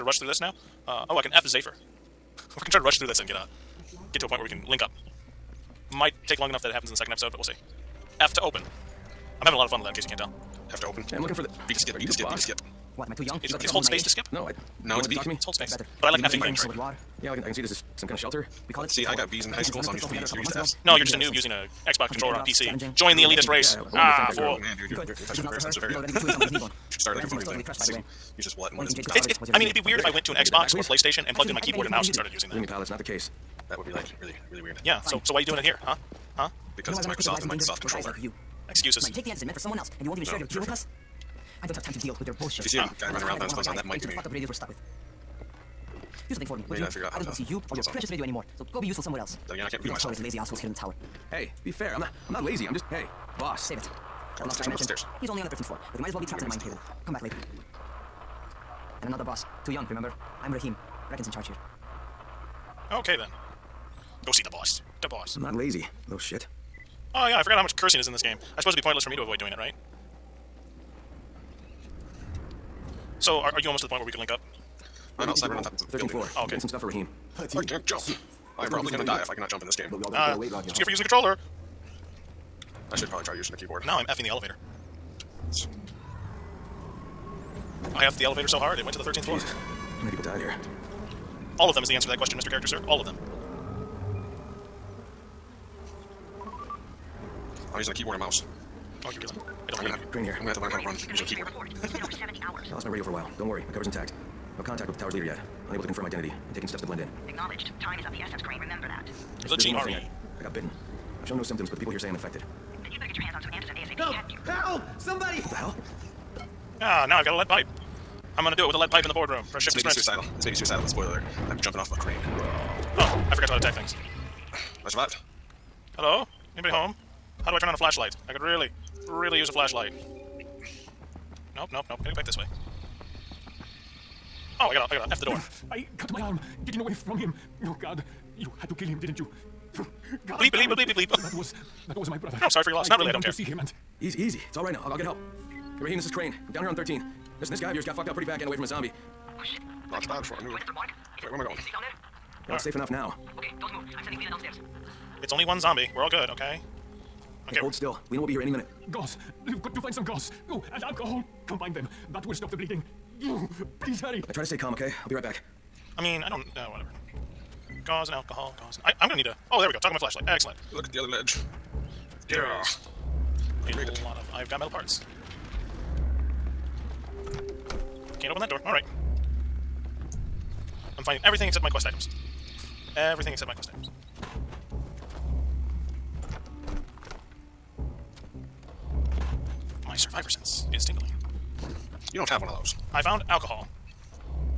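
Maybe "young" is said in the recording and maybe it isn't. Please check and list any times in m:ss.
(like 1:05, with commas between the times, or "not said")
0:13, 0:59.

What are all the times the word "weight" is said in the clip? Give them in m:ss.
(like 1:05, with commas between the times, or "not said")
1:20.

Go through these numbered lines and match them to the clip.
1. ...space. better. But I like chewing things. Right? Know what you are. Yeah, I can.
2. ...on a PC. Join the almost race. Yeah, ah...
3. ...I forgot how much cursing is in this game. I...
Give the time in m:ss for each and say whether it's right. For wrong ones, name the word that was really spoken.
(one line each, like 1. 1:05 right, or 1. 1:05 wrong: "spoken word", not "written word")
1. 0:15 wrong: "effing", not "chewing"
2. 0:22 wrong: "elitist", not "almost"
3. 1:07 right.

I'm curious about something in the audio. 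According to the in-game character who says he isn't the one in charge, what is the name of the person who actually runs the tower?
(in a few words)
Brecken.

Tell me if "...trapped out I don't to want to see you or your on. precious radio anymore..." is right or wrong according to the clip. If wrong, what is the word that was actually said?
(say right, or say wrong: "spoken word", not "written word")
wrong: "figured", not "trapped".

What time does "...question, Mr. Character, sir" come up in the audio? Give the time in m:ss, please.
1:32.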